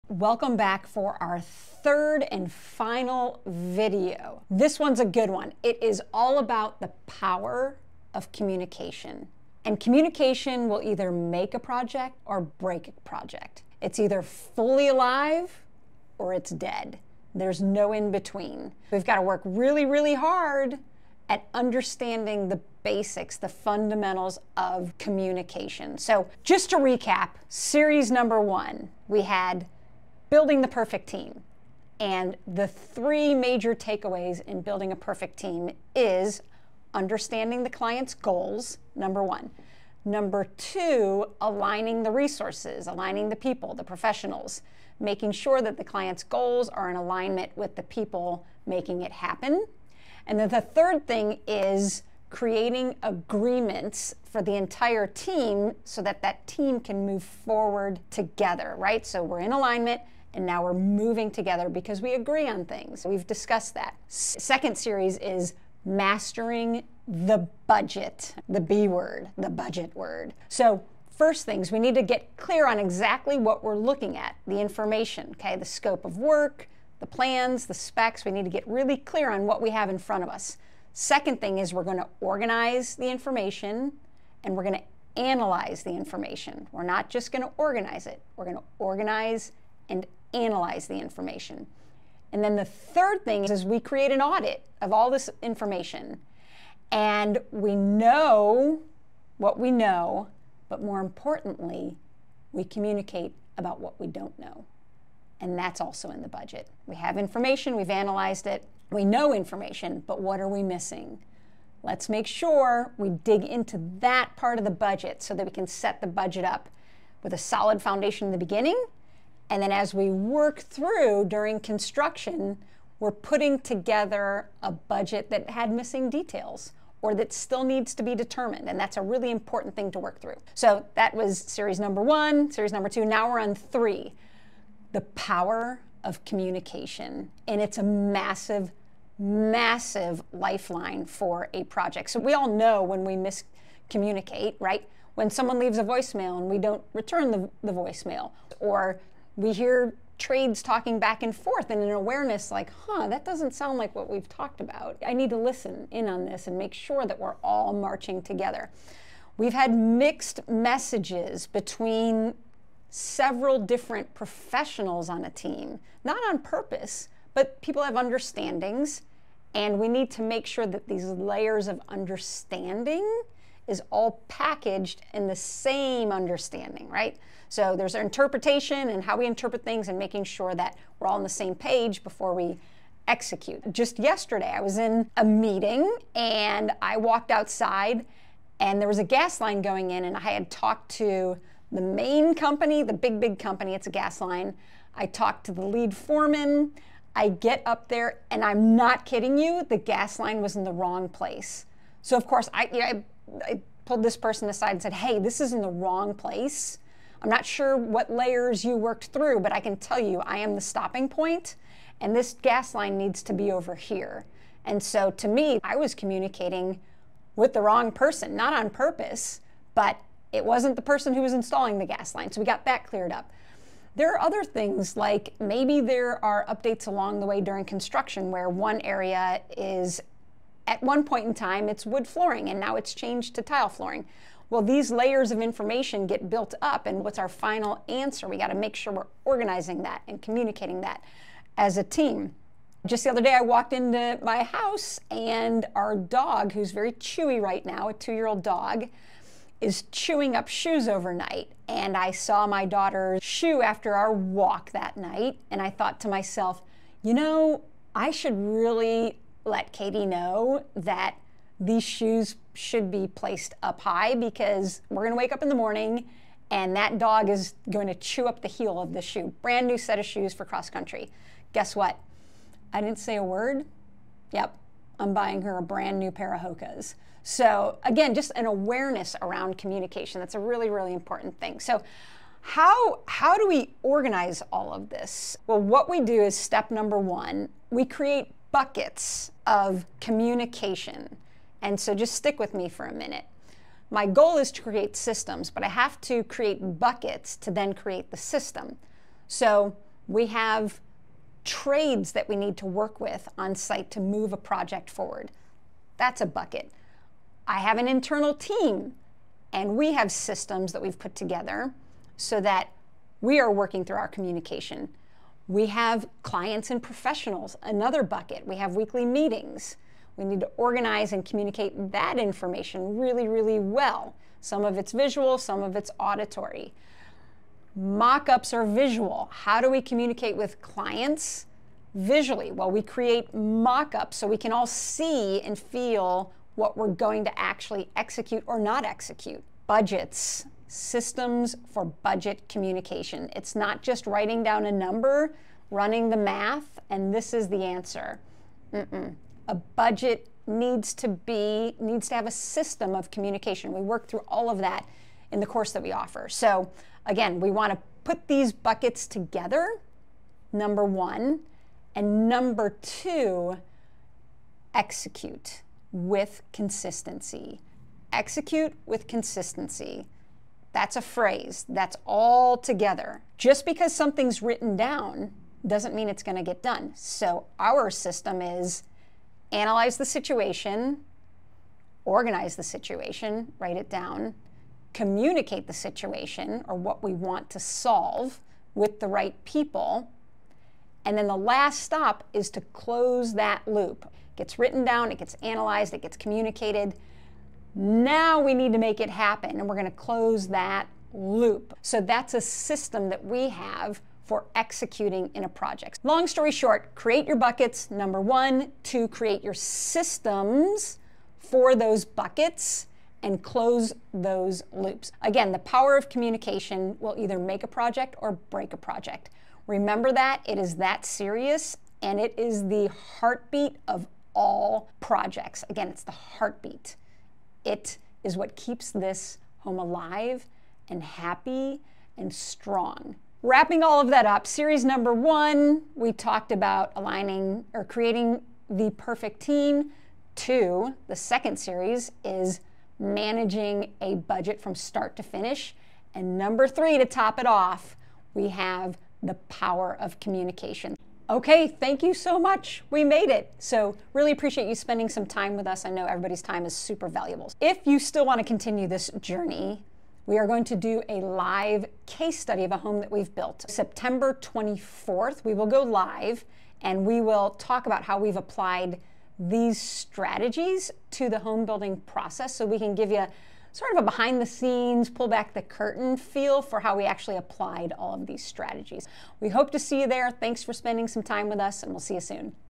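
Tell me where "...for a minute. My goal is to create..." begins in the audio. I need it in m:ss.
4:52.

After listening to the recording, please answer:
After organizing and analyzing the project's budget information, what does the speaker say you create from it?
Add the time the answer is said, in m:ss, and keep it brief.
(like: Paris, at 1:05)
An audit, at 1:34.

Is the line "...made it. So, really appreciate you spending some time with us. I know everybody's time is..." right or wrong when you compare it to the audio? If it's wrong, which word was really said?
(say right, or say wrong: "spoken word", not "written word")
right.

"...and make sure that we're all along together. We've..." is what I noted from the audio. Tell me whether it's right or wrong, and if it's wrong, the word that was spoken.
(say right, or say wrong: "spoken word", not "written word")
wrong: "marching", not "along".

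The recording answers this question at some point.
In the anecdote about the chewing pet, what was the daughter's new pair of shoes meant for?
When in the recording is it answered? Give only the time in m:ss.
4:30.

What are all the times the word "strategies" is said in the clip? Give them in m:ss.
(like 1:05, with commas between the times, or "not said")
7:49, 7:58.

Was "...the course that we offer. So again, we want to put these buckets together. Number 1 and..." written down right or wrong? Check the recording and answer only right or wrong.
right.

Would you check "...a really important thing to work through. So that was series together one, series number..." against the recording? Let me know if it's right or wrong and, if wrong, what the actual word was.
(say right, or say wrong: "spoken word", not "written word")
wrong: "number", not "together".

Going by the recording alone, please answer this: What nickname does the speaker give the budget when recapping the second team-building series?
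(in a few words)
The B word.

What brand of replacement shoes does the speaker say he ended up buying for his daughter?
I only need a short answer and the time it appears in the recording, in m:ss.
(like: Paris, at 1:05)
Hokas, at 4:36.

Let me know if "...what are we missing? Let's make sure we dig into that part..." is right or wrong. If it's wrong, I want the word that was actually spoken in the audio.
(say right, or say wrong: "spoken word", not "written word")
right.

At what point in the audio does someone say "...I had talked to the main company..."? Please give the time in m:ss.
3:10.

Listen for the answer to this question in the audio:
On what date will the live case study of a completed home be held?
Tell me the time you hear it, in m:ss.
7:43.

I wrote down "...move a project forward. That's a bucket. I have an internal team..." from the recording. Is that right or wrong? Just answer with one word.
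right.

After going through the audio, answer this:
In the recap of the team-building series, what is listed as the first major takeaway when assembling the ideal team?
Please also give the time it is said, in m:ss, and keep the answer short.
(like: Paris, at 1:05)
Understanding the client's goals, at 0:36.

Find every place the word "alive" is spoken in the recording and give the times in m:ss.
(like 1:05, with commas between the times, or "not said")
0:14, 7:09.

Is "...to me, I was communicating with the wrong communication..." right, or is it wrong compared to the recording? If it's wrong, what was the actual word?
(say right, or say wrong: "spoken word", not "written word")
wrong: "person", not "communication".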